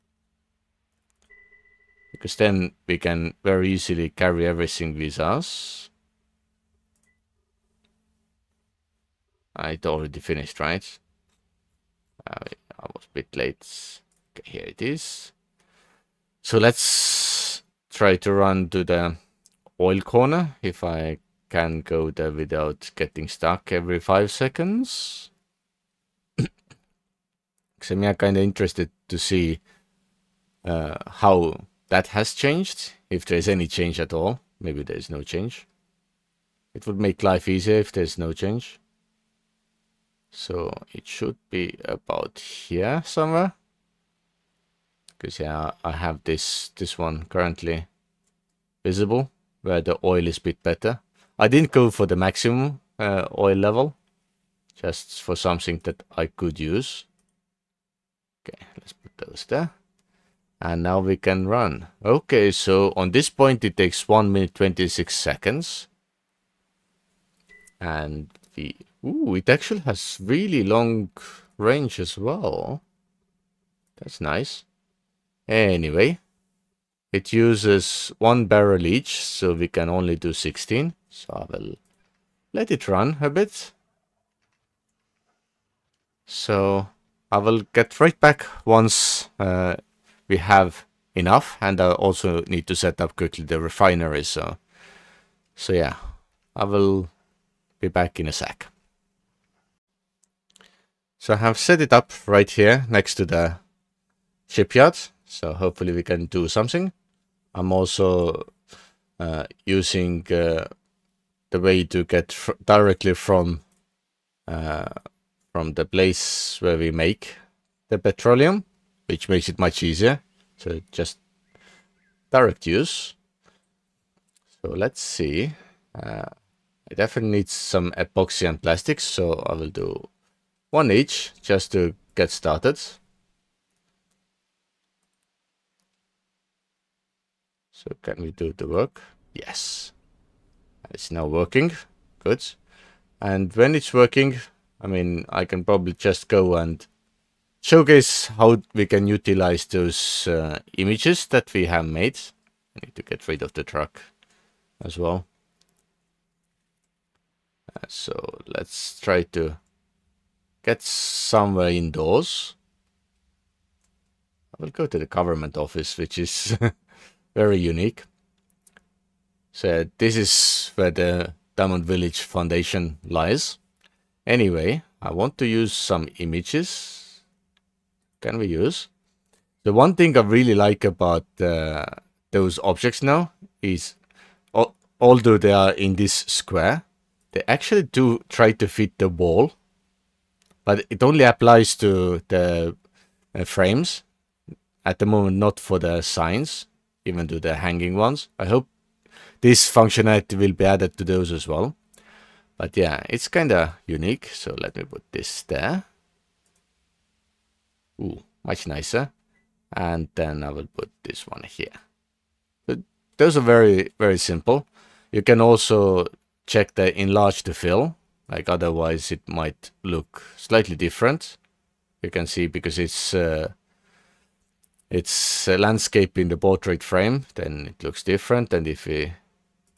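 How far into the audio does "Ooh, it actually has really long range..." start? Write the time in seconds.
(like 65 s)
69 s.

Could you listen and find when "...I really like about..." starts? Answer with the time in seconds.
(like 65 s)
180 s.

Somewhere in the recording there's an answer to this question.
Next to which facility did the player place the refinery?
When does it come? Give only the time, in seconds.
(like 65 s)
103 s.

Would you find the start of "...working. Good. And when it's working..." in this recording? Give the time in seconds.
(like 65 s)
141 s.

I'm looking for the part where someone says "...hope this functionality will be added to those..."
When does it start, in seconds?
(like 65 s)
198 s.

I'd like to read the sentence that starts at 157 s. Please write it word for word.
Uh, so let's try to get somewhere indoors.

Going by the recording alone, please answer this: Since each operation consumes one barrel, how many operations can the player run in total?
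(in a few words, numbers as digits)
16.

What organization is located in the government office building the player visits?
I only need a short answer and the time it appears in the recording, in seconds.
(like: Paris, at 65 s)
Diamond Village Foundation, at 171 s.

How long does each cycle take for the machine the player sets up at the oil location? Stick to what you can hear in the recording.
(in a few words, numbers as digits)
1 minute 26 seconds.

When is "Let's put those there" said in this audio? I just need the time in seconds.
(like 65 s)
58 s.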